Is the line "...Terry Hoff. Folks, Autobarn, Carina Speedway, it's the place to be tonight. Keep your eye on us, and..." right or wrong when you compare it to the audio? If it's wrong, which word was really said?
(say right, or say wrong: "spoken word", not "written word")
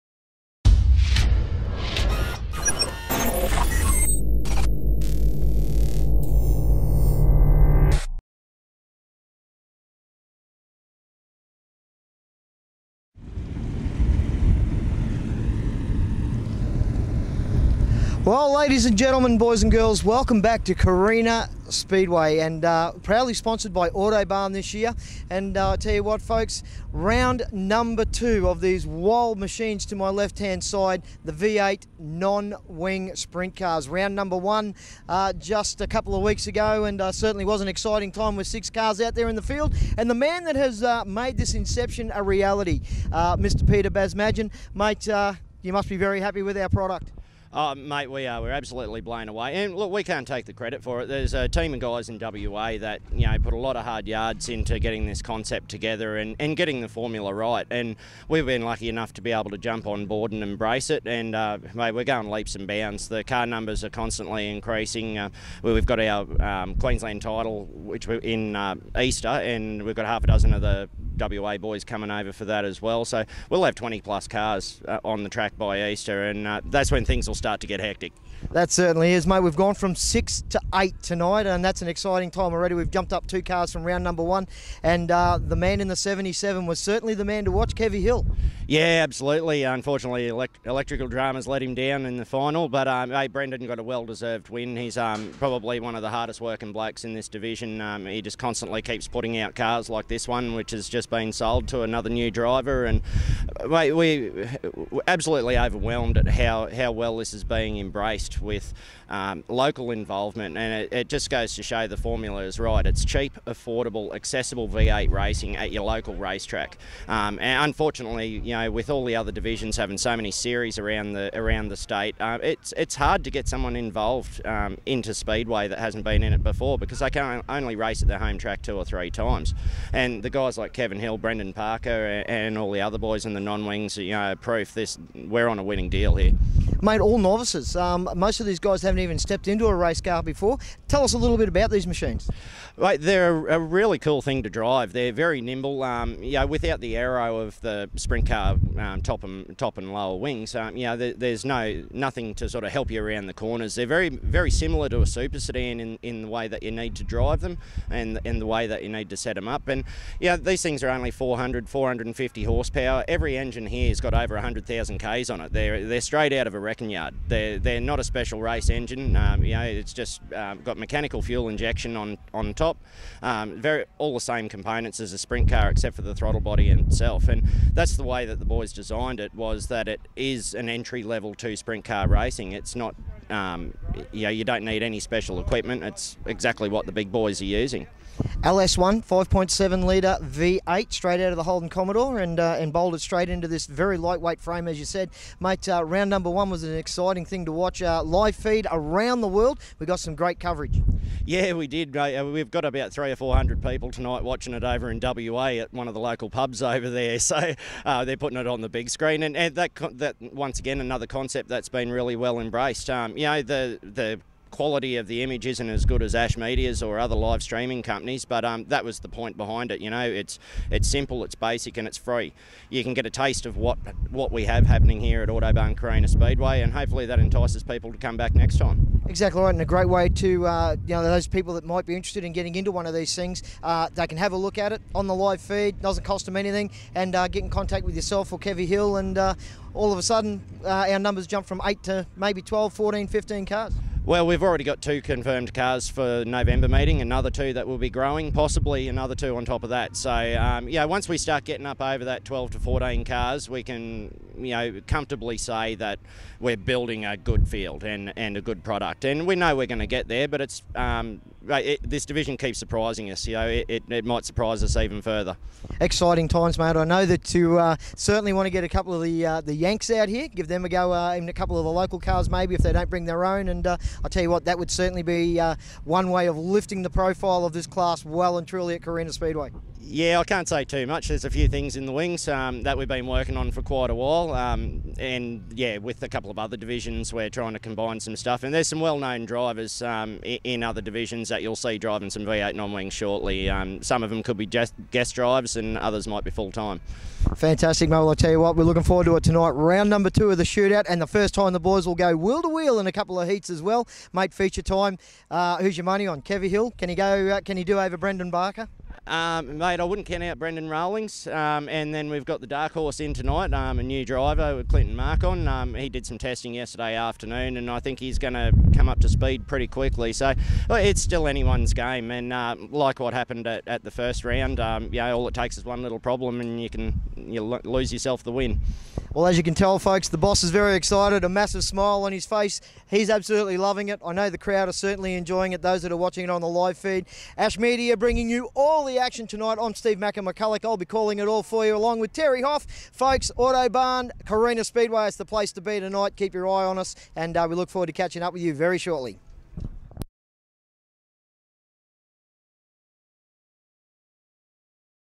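right.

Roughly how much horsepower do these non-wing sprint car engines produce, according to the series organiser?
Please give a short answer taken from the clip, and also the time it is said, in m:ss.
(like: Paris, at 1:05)
400 450 horsepower, at 2:41.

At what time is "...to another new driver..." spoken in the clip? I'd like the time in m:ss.
1:41.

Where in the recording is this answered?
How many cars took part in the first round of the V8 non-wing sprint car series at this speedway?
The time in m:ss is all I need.
0:38.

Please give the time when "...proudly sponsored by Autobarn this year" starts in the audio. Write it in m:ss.
0:23.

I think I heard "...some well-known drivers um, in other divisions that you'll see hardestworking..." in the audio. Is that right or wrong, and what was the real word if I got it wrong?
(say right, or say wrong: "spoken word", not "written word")
wrong: "driving", not "hardestworking".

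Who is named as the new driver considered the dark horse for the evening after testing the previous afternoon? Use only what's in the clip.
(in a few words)
Clinton Markon.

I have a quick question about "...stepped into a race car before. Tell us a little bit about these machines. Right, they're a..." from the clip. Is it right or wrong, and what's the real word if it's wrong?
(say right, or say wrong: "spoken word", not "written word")
right.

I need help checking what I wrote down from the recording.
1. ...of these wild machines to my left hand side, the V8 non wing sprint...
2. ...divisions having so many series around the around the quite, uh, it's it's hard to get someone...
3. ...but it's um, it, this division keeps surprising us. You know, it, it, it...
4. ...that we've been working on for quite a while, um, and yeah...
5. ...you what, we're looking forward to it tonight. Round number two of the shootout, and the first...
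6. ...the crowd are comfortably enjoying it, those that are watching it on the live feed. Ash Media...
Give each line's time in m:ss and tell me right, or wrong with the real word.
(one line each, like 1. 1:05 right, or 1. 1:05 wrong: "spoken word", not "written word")
1. 0:28 right
2. 1:59 wrong: "state", not "quite"
3. 4:20 right
4. 4:42 right
5. 4:58 right
6. 5:34 wrong: "certainly", not "comfortably".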